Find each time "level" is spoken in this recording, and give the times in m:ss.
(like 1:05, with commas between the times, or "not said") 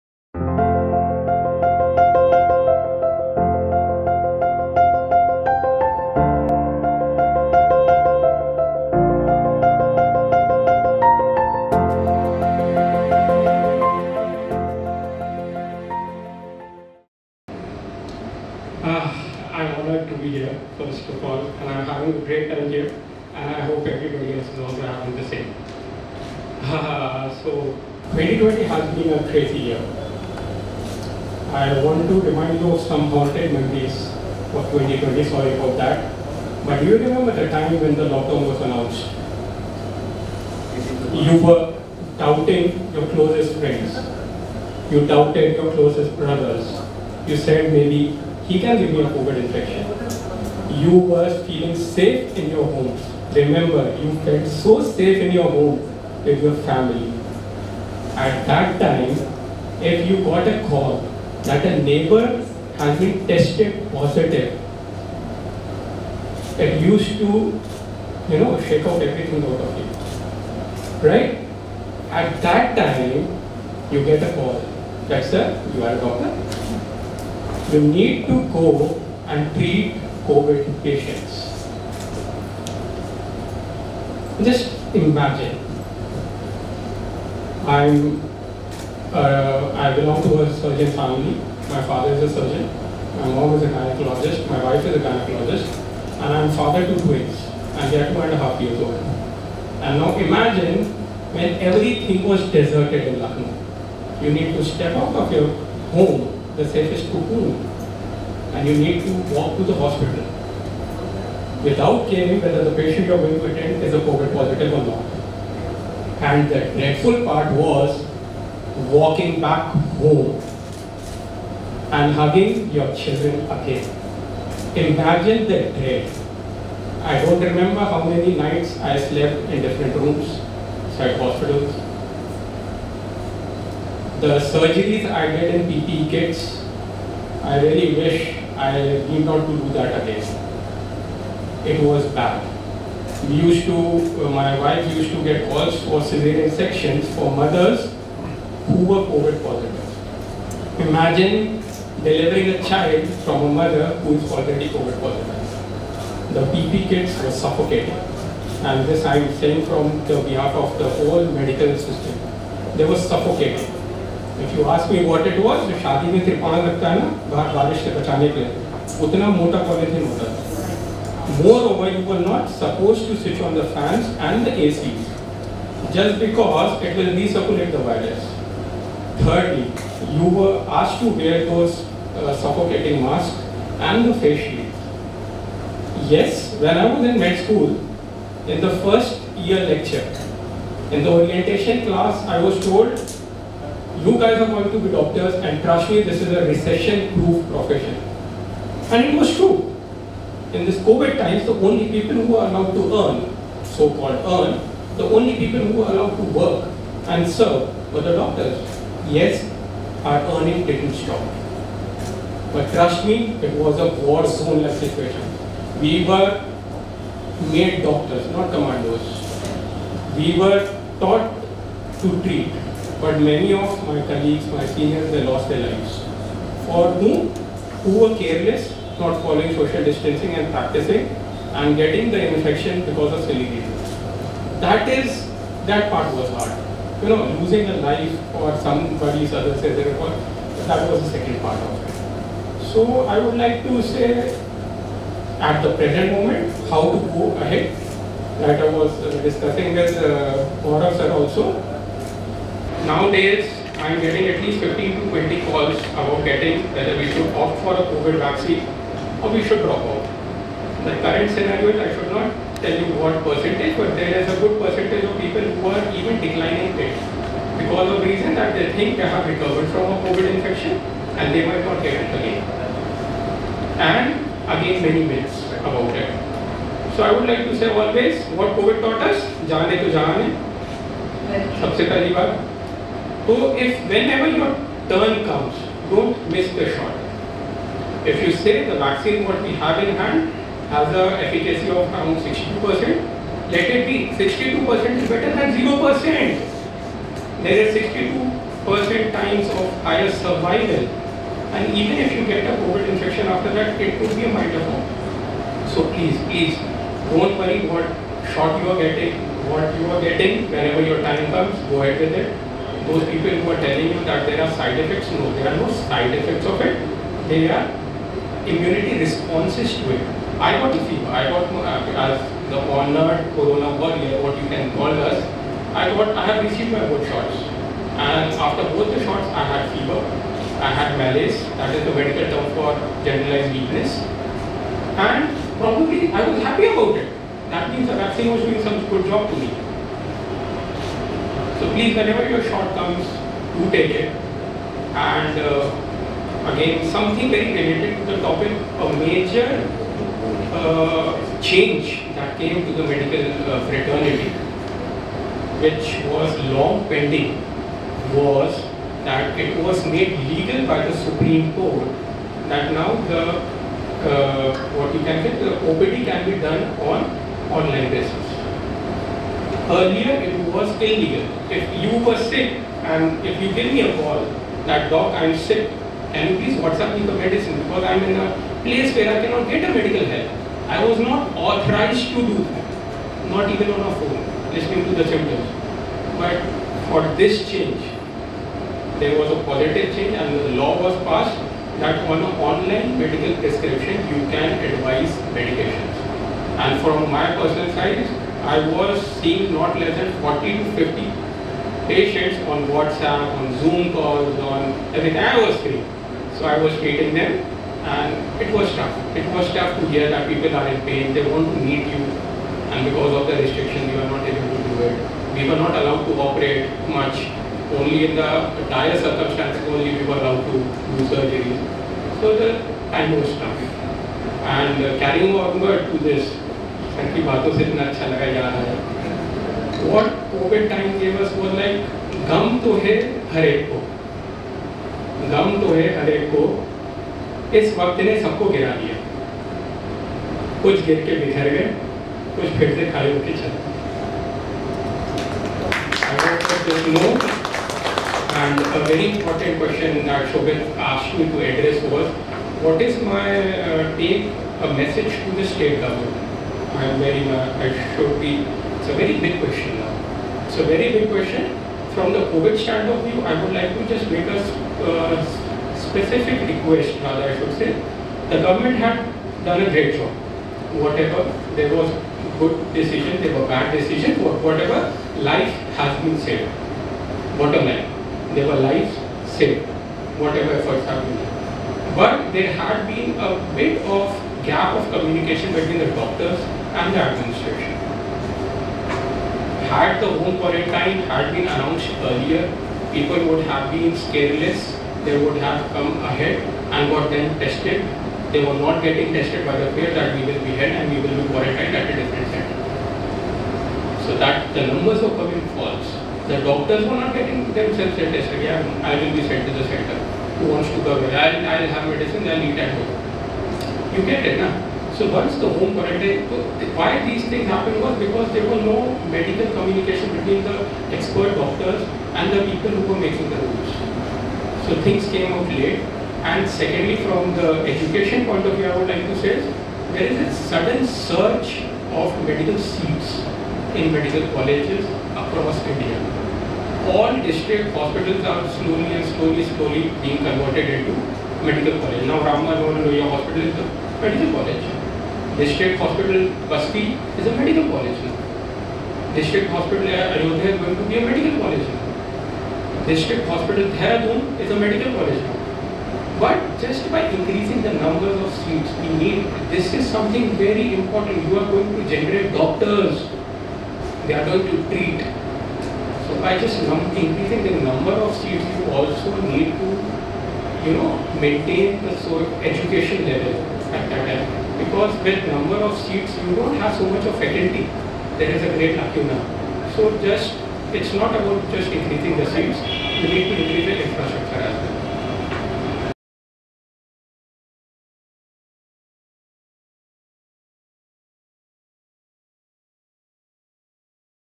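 9:33.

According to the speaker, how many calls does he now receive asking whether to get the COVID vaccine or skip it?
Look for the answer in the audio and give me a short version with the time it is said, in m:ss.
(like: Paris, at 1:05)
15 to 20, at 4:14.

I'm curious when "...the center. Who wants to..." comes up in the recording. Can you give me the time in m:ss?
8:29.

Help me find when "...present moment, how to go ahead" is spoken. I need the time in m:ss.
4:05.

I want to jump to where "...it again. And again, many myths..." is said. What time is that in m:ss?
4:32.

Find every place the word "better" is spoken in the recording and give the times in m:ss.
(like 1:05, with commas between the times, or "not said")
4:55.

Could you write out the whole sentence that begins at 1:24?
Just imagine, I'm, uh, I belong to a surgeon family.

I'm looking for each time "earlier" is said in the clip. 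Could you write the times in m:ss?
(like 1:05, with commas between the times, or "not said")
6:09, 8:12.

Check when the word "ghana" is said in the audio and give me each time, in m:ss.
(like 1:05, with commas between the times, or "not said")
not said.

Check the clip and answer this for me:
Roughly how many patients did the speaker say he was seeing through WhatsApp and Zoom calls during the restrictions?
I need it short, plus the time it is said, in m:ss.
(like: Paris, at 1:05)
40 to 50, at 6:40.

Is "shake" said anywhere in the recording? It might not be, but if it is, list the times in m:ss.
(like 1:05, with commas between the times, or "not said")
1:08.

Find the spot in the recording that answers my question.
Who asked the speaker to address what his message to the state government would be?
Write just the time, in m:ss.
7:30.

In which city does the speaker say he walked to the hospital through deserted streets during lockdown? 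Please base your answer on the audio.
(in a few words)
Lucknow.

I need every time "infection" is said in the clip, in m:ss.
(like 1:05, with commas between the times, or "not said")
0:49, 3:52, 4:30, 5:02.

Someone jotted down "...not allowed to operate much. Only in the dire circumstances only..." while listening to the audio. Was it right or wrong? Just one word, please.
right.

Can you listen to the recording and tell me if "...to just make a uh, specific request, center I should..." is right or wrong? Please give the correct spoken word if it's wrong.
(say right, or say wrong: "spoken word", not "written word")
wrong: "rather", not "center".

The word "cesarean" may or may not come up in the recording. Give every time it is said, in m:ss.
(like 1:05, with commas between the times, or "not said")
2:26.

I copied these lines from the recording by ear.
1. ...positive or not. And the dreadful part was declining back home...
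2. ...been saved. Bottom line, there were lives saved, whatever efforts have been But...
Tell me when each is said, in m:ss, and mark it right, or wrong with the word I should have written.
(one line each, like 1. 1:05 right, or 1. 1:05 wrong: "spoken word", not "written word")
1. 1:54 wrong: "walking", not "declining"
2. 7:56 right.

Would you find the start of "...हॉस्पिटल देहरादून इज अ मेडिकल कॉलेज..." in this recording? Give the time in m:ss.
9:13.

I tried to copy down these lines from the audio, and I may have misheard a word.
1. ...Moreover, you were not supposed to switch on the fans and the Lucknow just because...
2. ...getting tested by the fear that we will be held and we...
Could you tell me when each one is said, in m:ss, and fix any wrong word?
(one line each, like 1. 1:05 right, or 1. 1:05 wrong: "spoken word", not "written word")
1. 2:51 wrong: "ACs", not "Lucknow"
2. 8:18 right.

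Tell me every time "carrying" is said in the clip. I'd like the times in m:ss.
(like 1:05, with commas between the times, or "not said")
7:04.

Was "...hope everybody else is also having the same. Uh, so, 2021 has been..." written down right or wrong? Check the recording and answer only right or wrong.
wrong.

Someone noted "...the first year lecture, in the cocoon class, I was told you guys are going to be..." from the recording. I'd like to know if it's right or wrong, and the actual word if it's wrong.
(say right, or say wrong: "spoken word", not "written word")
wrong: "orientation", not "cocoon".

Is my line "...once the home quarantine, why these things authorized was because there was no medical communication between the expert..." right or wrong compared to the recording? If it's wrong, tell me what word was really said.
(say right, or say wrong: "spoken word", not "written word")
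wrong: "happened", not "authorized".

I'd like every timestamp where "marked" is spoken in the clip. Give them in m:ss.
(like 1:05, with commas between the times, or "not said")
not said.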